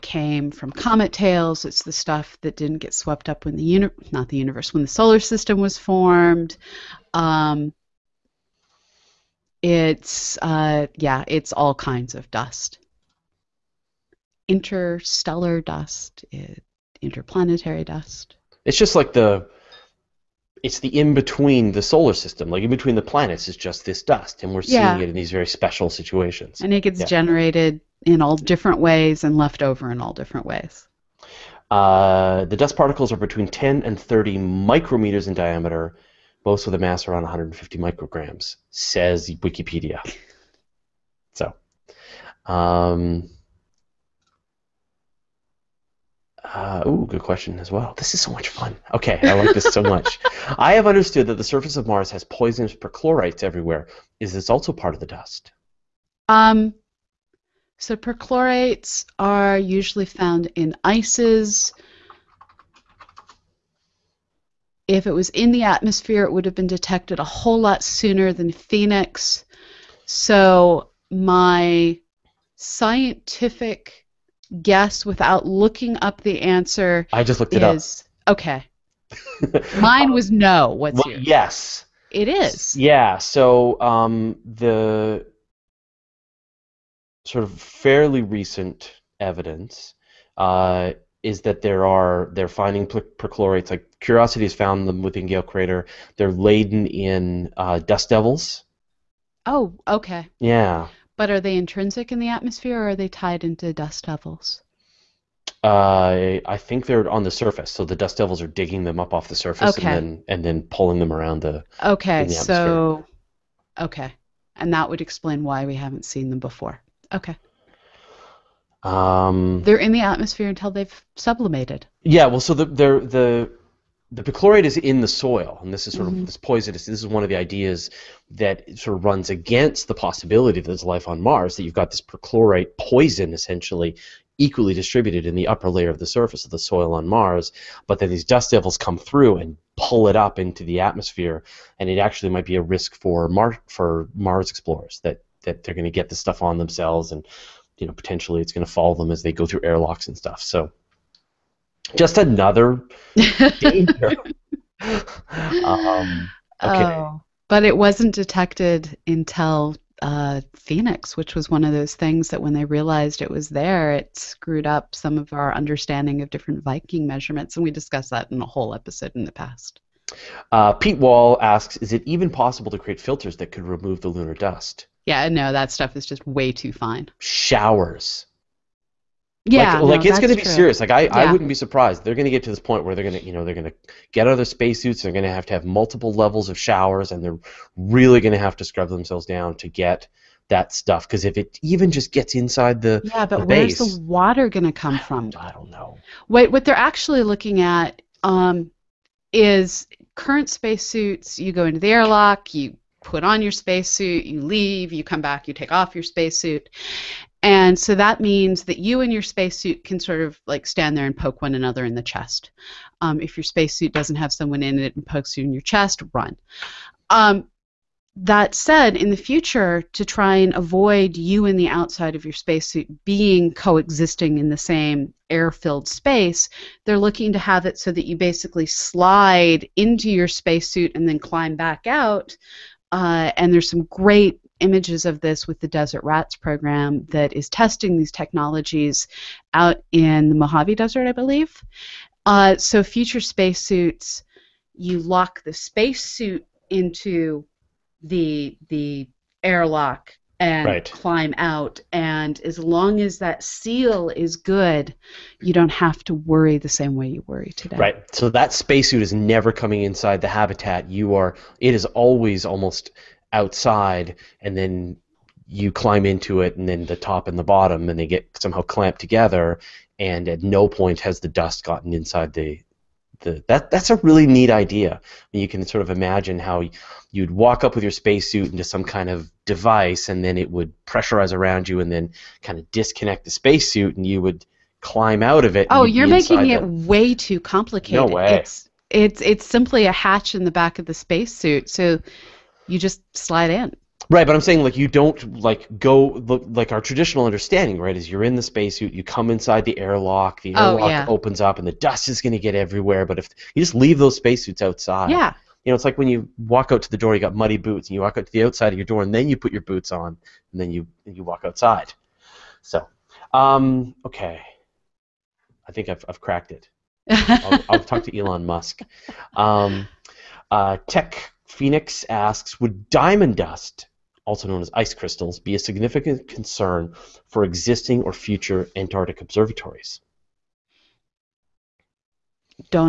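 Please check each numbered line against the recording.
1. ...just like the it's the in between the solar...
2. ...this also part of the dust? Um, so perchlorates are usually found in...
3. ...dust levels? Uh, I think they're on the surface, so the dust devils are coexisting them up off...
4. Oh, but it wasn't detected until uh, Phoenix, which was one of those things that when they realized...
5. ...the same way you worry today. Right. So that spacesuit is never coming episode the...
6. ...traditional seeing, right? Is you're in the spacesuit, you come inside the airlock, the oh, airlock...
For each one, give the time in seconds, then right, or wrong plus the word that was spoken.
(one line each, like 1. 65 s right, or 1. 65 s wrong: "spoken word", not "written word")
1. 18 s right
2. 54 s right
3. 103 s wrong: "digging", not "coexisting"
4. 156 s right
5. 256 s wrong: "inside", not "episode"
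6. 296 s wrong: "understanding", not "seeing".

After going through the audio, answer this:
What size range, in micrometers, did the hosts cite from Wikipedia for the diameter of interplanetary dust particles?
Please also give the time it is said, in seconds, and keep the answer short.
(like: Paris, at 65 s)
10 to 30, at 33 s.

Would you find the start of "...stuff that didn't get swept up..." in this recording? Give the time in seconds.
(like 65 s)
1 s.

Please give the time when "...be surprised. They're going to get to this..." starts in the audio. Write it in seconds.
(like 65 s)
181 s.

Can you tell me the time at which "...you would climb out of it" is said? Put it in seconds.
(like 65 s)
284 s.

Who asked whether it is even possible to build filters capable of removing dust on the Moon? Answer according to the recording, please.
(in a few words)
Pete Wall.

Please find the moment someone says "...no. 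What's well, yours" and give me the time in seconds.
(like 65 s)
80 s.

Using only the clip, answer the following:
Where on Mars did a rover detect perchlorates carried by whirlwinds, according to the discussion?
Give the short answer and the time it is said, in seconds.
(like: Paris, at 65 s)
Gale Crater, at 95 s.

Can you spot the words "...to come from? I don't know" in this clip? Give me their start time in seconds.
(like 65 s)
194 s.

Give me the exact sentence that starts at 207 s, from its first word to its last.
And so that means that you and your spacesuit can sort of like stand there and poke one another in the chest.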